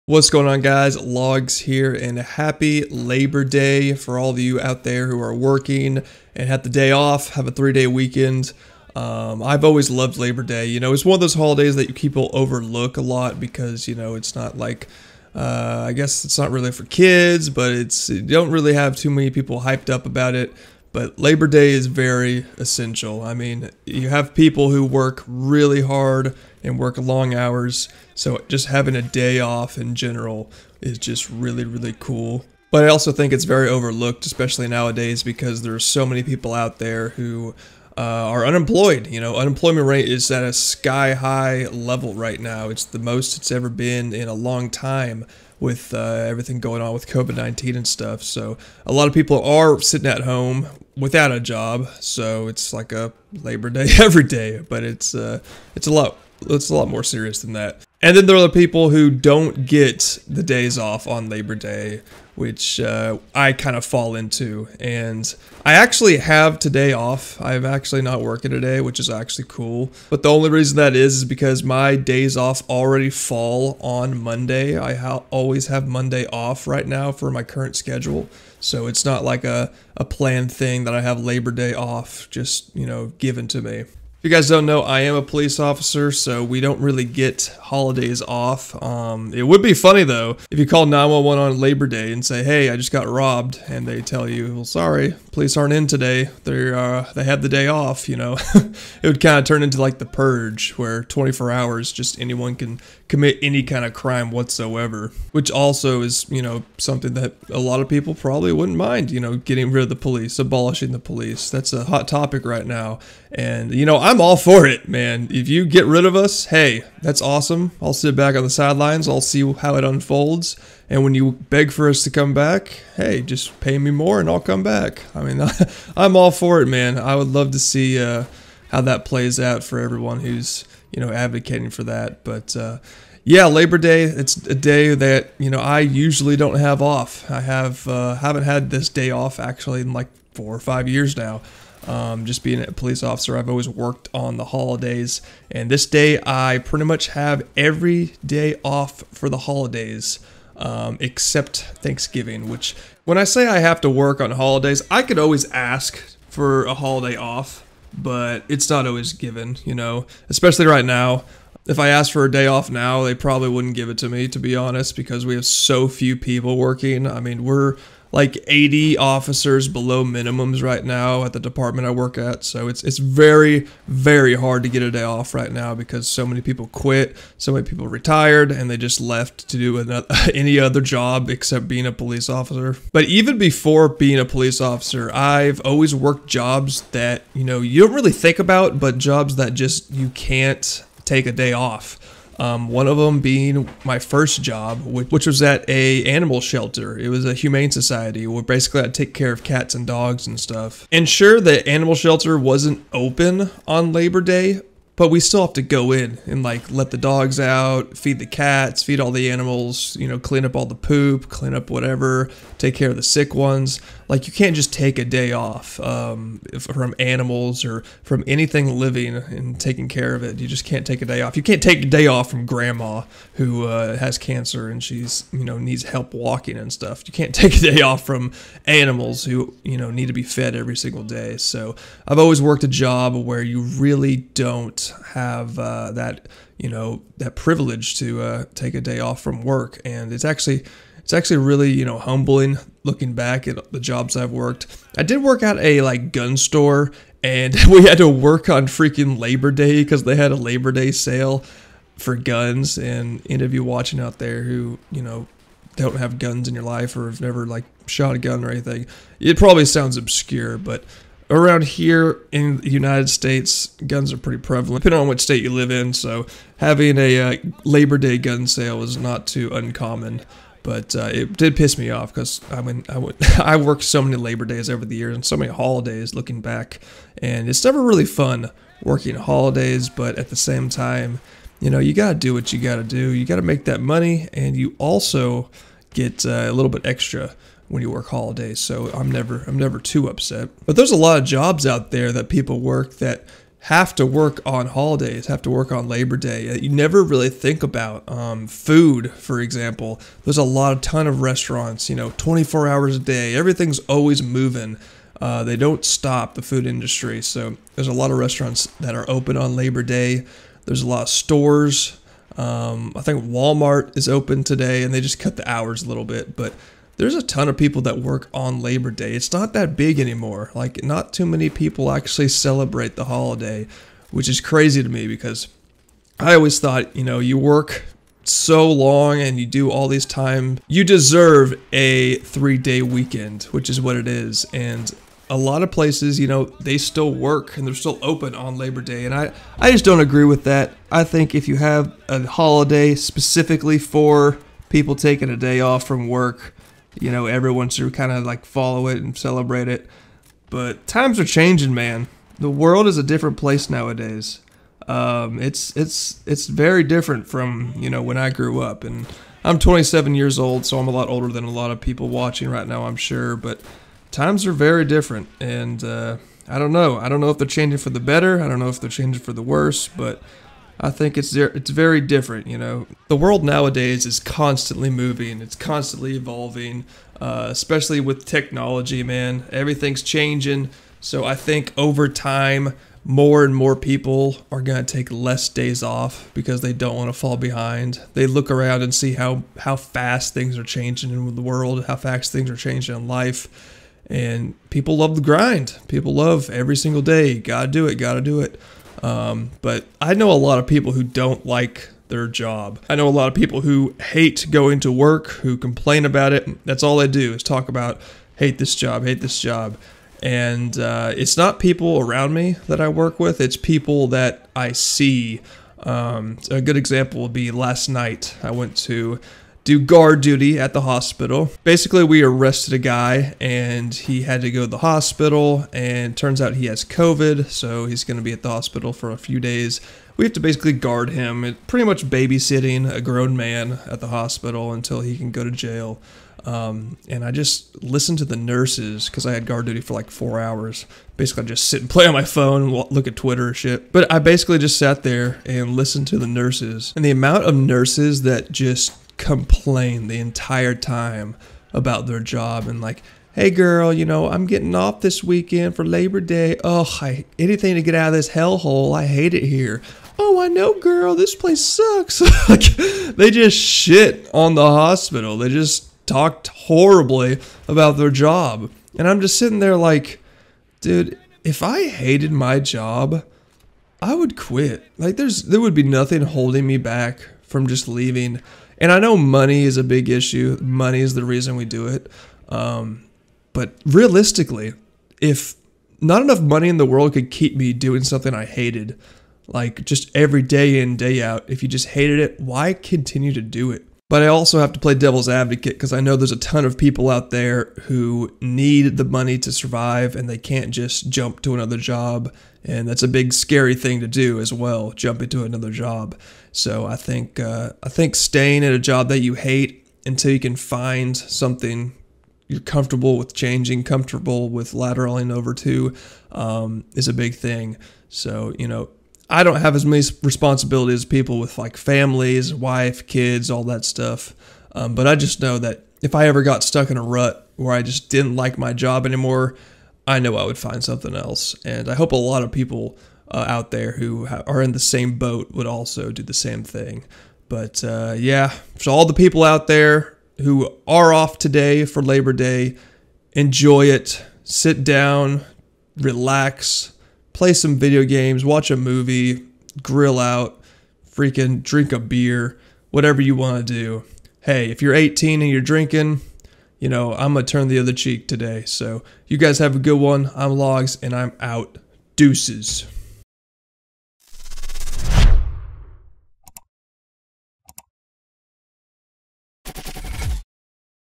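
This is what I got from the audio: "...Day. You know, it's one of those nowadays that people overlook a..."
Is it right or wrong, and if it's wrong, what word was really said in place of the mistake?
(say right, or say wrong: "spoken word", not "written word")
wrong: "holidays", not "nowadays".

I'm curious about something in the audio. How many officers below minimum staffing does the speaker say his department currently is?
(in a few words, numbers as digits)
80.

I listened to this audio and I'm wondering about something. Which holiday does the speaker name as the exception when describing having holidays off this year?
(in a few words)
Thanksgiving.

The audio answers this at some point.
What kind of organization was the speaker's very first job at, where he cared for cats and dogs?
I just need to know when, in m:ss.
3:17.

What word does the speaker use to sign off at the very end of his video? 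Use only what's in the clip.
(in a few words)
Deuces.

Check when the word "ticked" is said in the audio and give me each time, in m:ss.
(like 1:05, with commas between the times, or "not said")
not said.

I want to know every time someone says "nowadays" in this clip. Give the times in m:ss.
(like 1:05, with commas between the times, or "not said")
0:34, 5:53, 6:13.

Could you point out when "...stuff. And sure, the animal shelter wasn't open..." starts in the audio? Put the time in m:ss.
3:20.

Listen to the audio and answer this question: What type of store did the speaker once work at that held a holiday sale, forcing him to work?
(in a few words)
Gun store.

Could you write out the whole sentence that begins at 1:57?
I'll sit back on the sidelines, I'll see how it unfolds.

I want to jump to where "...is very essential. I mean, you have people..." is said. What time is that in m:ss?
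0:21.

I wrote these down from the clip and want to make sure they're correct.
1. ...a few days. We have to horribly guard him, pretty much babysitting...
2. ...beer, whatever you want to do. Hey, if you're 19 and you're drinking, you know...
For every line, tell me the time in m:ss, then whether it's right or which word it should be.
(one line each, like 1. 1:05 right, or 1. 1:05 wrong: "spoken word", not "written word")
1. 7:09 wrong: "basically", not "horribly"
2. 9:11 wrong: "18", not "19".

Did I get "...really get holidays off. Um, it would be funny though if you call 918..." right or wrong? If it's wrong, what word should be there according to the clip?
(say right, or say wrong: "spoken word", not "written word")
wrong: "911", not "918".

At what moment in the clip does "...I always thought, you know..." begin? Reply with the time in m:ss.
5:26.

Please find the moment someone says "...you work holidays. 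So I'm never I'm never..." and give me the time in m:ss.
4:47.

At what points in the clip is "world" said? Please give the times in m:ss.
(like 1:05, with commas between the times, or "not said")
5:52, 6:13, 6:31, 8:06.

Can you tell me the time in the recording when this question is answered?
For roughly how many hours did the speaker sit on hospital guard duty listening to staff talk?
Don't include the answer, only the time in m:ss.
7:20.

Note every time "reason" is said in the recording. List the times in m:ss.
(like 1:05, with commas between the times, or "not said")
1:10, 8:01.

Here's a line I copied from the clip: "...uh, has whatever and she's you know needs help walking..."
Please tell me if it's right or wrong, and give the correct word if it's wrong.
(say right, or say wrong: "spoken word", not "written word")
wrong: "cancer", not "whatever".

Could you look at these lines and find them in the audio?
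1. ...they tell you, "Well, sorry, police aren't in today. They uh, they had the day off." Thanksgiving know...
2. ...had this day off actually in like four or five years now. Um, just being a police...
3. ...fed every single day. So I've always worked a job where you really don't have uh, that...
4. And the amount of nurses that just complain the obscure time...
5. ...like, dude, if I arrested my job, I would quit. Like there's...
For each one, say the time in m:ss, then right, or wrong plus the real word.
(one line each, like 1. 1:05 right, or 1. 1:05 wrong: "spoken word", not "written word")
1. 1:33 wrong: "You", not "Thanksgiving"
2. 2:18 right
3. 3:50 right
4. 7:26 wrong: "entire", not "obscure"
5. 7:49 wrong: "hated", not "arrested".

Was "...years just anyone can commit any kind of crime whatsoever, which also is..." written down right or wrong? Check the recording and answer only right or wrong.
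wrong.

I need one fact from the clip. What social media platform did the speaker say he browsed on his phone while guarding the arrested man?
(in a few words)
Twitter.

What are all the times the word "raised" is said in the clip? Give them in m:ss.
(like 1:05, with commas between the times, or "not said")
not said.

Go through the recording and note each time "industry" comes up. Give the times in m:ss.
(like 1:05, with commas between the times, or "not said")
5:06.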